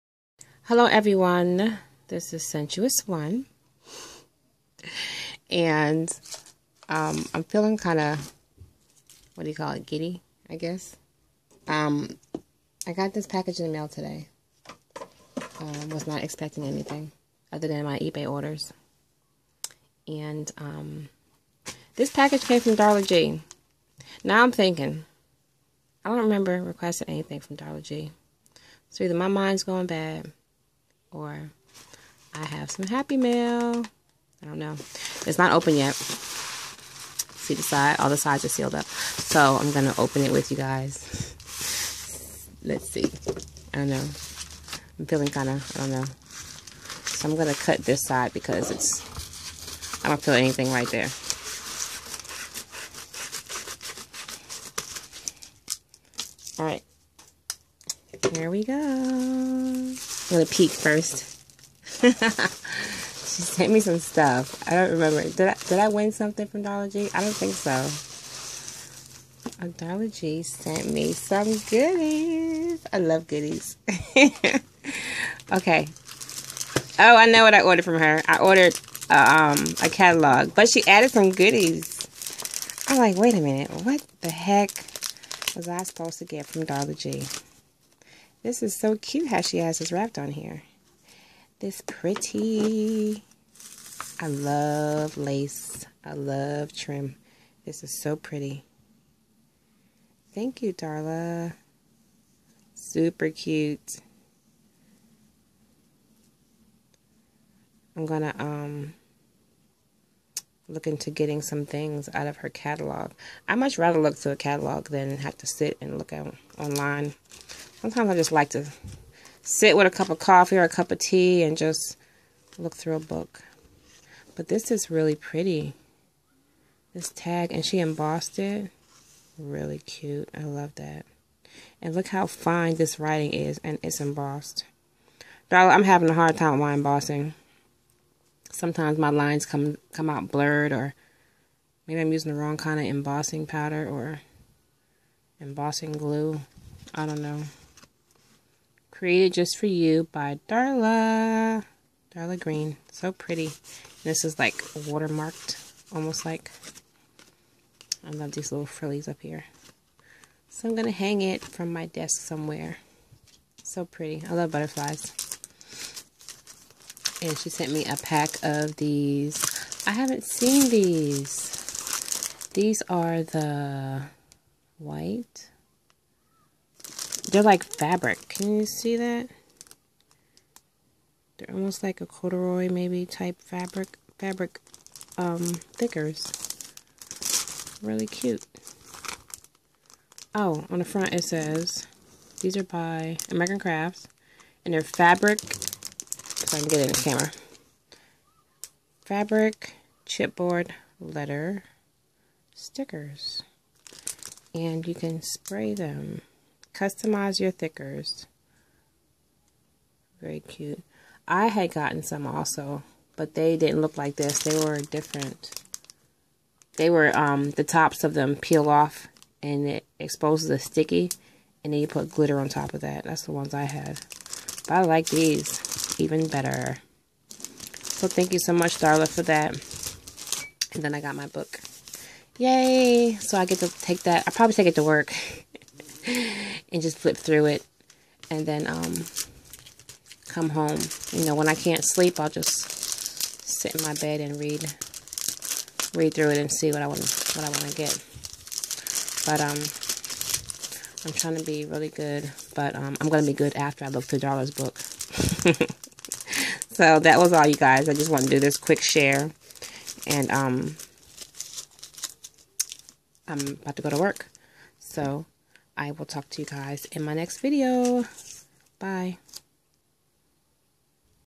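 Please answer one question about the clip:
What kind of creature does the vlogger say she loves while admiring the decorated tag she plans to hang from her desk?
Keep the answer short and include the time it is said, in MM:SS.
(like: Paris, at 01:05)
Butterflies, at 02:44.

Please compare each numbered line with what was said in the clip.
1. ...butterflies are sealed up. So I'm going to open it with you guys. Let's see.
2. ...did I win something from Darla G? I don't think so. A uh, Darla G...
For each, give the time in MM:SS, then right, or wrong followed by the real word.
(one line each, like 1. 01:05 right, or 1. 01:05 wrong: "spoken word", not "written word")
1. 00:38 wrong: "sides", not "butterflies"
2. 01:05 right.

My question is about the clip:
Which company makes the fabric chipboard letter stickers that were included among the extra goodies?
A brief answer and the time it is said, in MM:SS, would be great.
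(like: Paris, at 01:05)
American Crafts, at 03:13.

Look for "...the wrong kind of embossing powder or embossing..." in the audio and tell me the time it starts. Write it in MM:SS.
02:22.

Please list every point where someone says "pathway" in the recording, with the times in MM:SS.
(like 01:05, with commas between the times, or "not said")
not said.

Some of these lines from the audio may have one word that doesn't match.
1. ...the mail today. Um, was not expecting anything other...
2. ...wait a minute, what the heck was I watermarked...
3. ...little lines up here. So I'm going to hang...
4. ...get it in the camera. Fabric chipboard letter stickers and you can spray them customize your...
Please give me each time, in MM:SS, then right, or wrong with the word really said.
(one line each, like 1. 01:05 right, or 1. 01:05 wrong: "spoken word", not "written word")
1. 00:13 right
2. 01:23 wrong: "supposed", not "watermarked"
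3. 02:38 wrong: "frillies", not "lines"
4. 03:16 right.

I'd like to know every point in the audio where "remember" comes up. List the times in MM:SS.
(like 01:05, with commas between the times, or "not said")
00:26, 01:04.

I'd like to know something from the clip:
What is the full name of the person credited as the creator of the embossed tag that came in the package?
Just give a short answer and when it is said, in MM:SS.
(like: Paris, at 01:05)
Darla Green, at 02:32.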